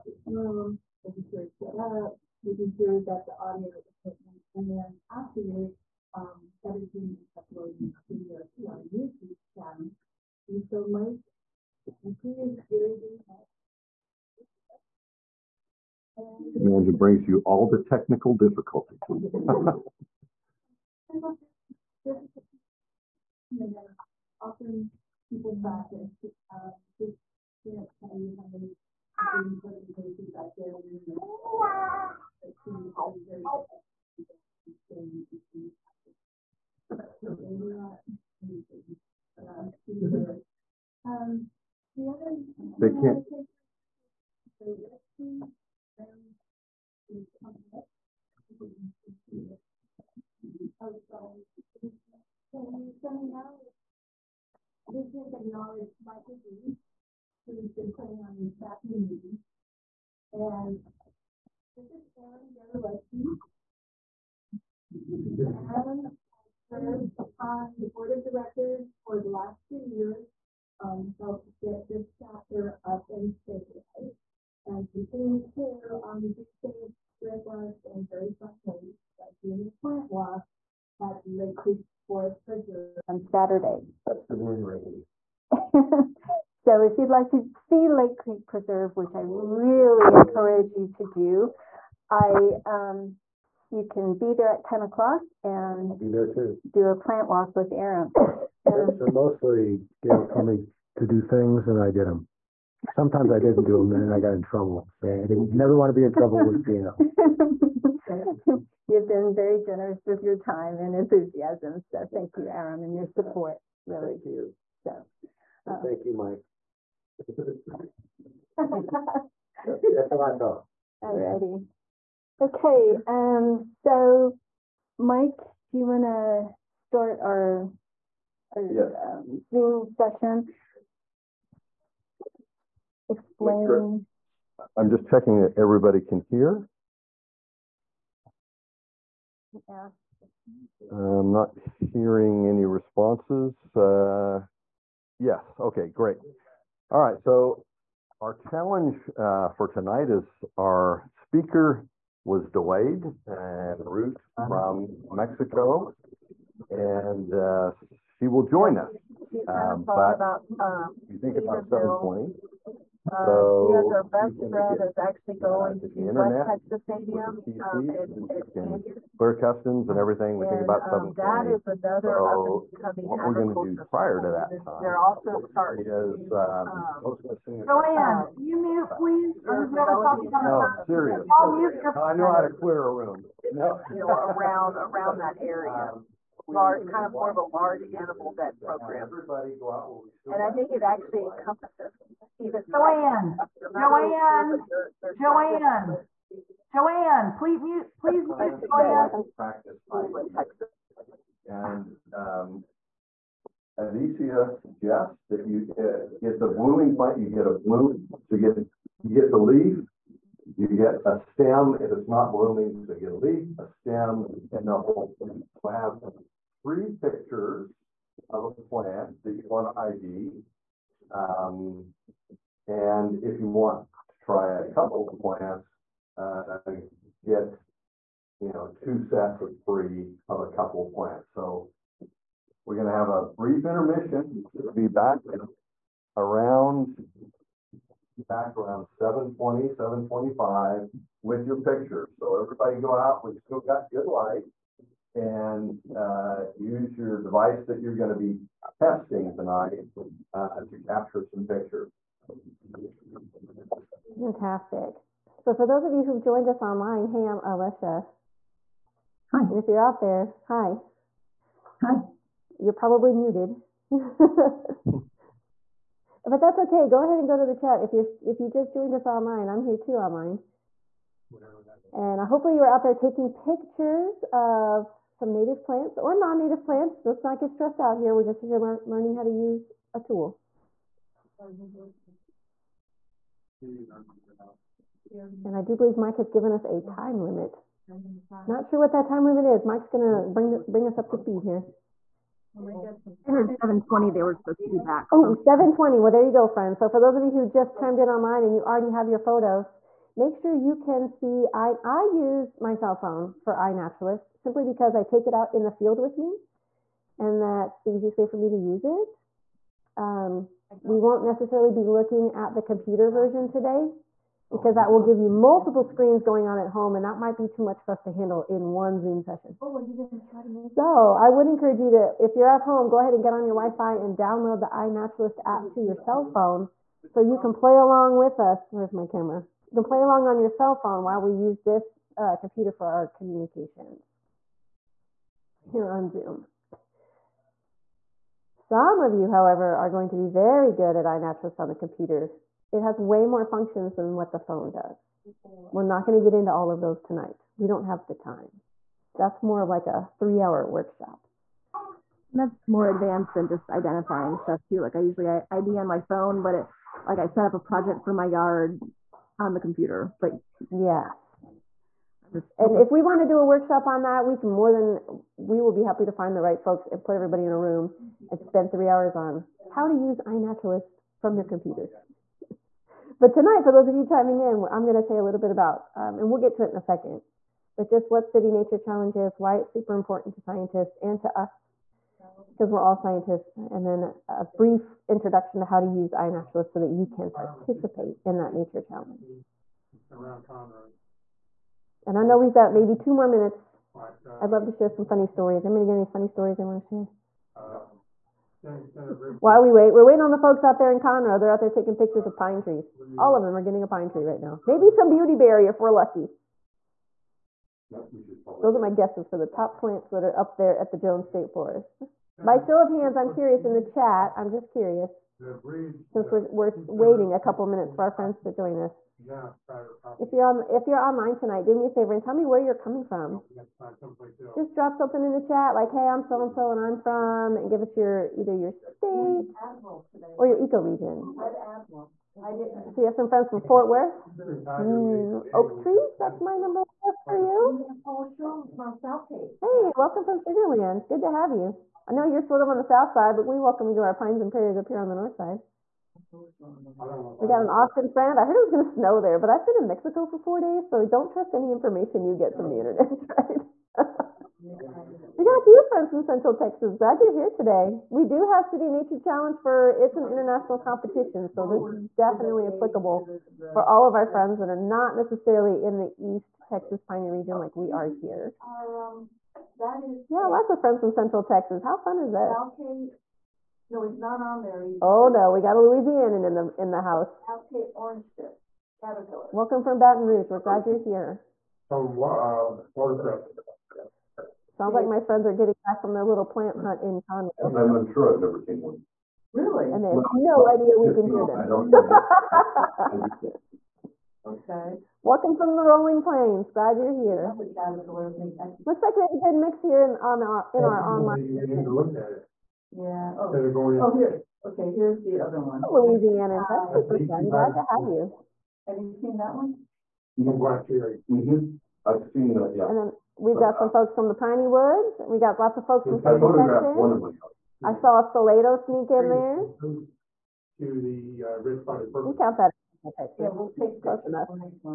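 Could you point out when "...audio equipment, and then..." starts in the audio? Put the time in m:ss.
0:03.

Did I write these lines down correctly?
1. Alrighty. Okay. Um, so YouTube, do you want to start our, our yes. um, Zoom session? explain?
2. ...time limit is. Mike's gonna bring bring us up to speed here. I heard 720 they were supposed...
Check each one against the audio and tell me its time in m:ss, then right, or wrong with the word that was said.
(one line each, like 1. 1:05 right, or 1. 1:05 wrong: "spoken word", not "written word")
1. 2:01 wrong: "Mike", not "YouTube"
2. 4:49 right.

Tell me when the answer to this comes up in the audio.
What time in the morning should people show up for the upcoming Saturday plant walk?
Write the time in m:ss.
1:34.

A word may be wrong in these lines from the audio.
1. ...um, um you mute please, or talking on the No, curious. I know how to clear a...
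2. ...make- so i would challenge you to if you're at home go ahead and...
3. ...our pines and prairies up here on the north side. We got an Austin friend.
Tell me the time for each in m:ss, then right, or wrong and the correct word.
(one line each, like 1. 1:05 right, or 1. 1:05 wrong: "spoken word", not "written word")
1. 2:56 wrong: "serious", not "curious"
2. 5:20 wrong: "encourage", not "challenge"
3. 7:24 right.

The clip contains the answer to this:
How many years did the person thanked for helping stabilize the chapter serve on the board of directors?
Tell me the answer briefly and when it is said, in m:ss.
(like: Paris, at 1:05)
2, at 1:09.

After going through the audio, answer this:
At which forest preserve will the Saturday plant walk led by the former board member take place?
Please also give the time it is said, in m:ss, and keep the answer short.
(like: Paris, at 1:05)
Lake Creek Forest Preserve, at 1:21.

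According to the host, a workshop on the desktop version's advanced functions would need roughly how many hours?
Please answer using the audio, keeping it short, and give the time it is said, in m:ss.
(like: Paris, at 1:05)
3, at 5:50.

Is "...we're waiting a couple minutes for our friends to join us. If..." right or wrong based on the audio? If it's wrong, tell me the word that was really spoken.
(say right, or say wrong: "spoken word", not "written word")
right.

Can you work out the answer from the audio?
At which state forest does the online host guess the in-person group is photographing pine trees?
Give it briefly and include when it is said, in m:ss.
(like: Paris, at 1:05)
Jones State Forest, at 6:50.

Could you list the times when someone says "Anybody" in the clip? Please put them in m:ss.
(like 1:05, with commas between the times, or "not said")
6:35.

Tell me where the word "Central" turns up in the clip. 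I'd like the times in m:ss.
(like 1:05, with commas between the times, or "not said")
7:36, 7:51, 8:36.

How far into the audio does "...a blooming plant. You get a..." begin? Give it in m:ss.
3:26.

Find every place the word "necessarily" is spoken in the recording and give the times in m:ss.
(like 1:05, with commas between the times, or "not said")
5:11, 7:45.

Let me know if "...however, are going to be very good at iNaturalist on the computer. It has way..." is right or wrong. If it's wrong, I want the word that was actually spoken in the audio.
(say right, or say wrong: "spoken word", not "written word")
right.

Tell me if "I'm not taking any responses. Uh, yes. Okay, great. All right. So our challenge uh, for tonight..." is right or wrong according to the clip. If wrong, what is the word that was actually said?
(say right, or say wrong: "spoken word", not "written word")
wrong: "hearing", not "taking".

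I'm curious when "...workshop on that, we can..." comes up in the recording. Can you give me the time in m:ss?
6:03.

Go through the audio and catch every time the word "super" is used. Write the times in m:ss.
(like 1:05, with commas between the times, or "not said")
6:19, 8:26.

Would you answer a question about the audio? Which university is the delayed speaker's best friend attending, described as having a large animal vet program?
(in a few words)
West Texas A&M.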